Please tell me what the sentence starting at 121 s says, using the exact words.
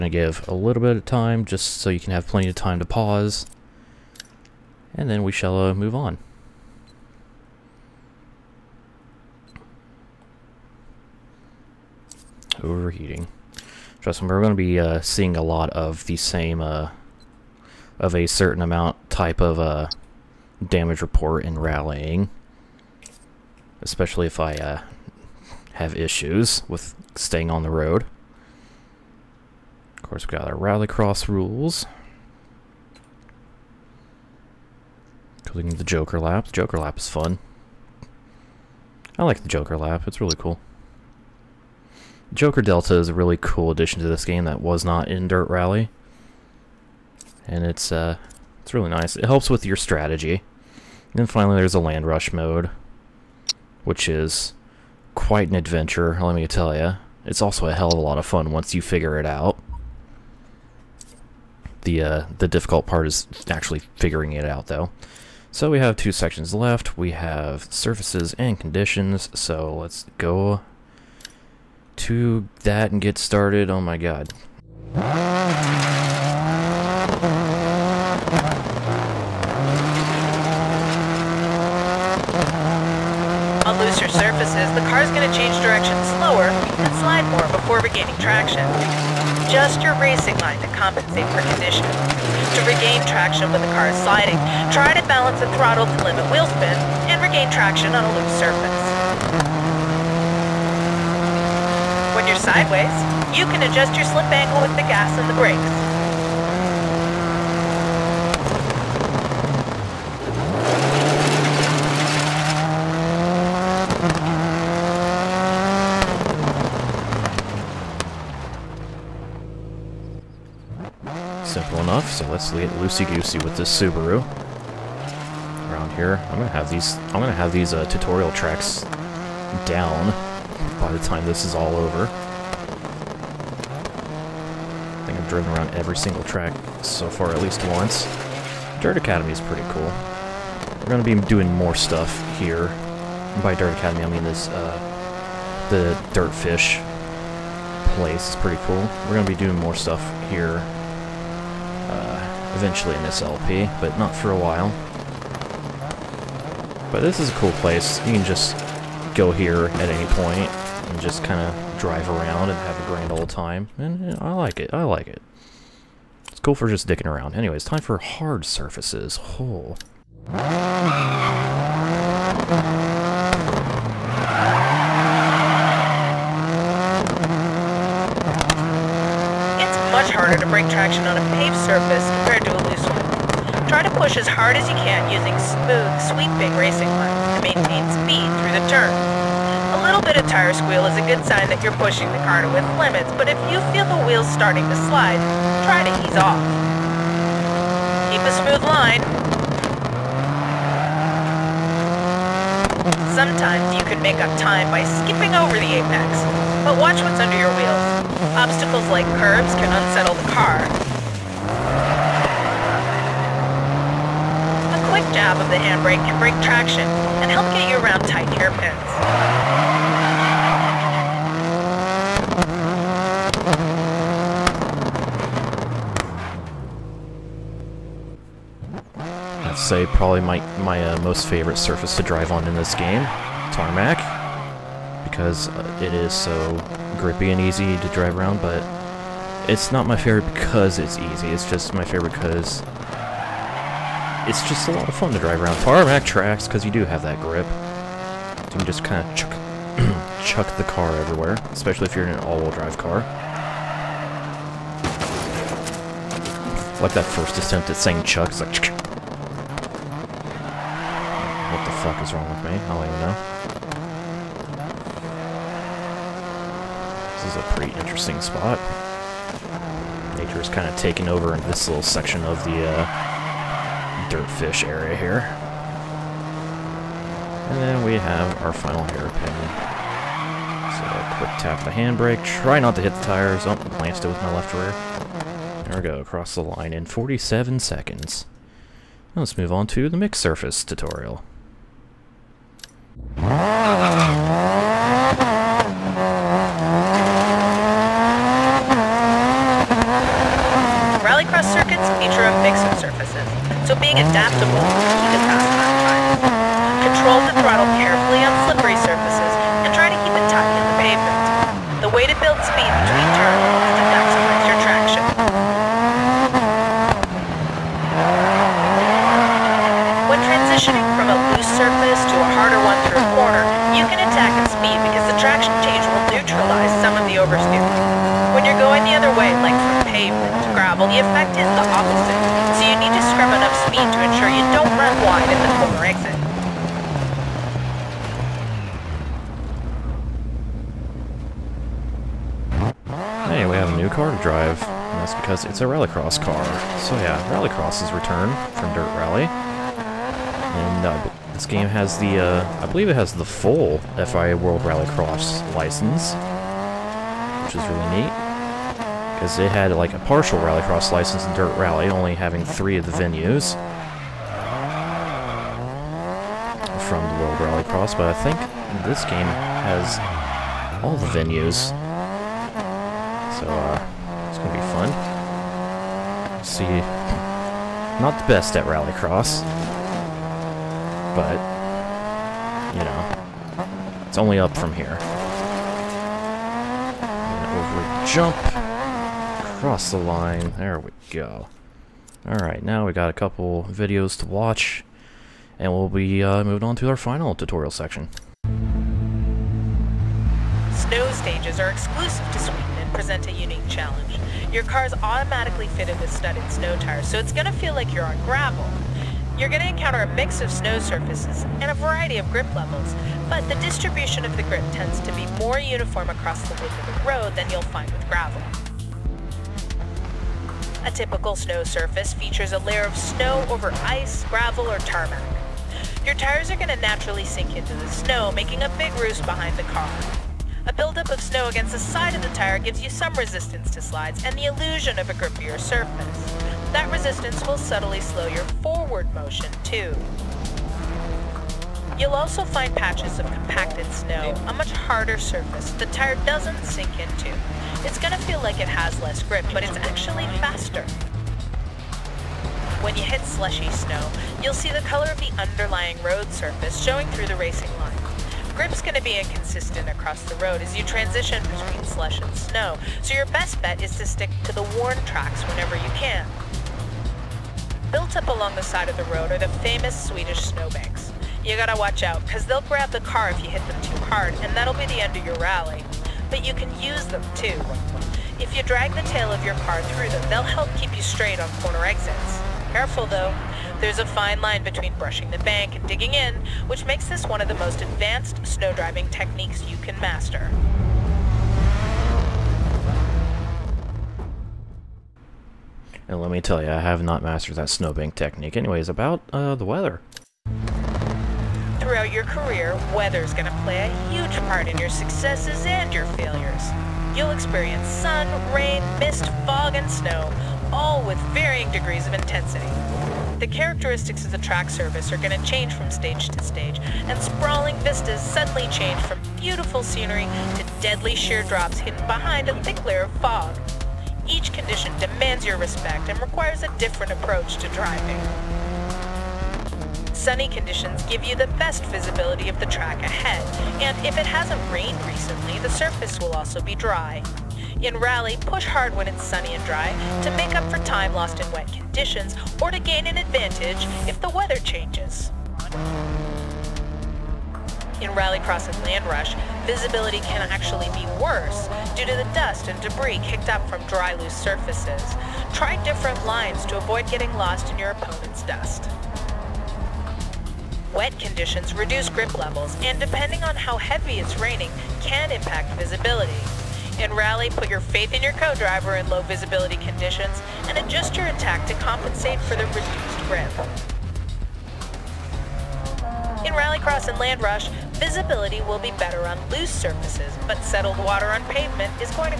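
Simple enough, so let's get loosey-goosey with this Subaru.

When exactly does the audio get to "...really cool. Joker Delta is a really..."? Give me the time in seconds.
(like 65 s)
40 s.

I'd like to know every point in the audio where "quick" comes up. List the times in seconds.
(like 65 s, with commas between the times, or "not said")
214 s, 281 s.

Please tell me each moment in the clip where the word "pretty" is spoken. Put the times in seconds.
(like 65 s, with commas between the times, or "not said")
139 s, 148 s, 267 s.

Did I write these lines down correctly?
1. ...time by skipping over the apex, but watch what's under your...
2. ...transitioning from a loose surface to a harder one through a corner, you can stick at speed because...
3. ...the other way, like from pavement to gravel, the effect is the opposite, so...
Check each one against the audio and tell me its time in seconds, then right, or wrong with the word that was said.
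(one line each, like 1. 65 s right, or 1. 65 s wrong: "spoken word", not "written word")
1. 204 s right
2. 320 s wrong: "attack", not "stick"
3. 328 s right.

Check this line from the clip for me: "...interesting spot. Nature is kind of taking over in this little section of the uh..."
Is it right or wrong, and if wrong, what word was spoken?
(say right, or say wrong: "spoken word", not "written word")
right.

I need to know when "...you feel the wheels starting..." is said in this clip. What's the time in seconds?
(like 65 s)
193 s.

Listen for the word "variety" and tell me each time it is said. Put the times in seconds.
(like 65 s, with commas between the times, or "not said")
411 s.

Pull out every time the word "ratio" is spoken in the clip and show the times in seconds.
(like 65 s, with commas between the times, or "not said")
not said.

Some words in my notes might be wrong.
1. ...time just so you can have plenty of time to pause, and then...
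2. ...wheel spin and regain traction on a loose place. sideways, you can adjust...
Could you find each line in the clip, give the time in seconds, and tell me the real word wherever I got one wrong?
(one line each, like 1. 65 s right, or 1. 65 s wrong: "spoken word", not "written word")
1. 1 s right
2. 96 s wrong: "surface", not "place".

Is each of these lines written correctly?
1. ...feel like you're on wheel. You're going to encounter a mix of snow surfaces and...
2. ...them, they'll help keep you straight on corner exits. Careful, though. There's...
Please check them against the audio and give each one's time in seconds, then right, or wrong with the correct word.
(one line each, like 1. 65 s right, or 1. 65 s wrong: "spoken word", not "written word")
1. 407 s wrong: "gravel", not "wheel"
2. 480 s right.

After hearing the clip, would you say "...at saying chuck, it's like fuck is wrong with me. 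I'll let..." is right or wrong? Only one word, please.
right.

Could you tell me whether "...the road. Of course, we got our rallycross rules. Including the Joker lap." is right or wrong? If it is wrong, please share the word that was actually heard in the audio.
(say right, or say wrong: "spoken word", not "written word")
right.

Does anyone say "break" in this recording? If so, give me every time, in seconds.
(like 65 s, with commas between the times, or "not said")
180 s, 216 s.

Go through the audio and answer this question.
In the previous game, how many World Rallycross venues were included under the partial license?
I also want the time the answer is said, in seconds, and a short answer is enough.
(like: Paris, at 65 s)
3, at 362 s.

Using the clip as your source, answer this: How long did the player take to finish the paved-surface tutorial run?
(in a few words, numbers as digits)
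47 seconds.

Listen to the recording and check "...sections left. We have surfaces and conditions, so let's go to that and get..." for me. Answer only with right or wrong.
right.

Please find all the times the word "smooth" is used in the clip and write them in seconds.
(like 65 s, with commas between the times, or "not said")
185 s, 198 s.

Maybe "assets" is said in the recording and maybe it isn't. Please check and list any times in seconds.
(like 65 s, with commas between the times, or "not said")
not said.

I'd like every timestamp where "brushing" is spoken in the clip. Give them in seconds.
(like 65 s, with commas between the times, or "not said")
484 s.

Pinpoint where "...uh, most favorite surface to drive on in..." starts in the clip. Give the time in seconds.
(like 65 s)
230 s.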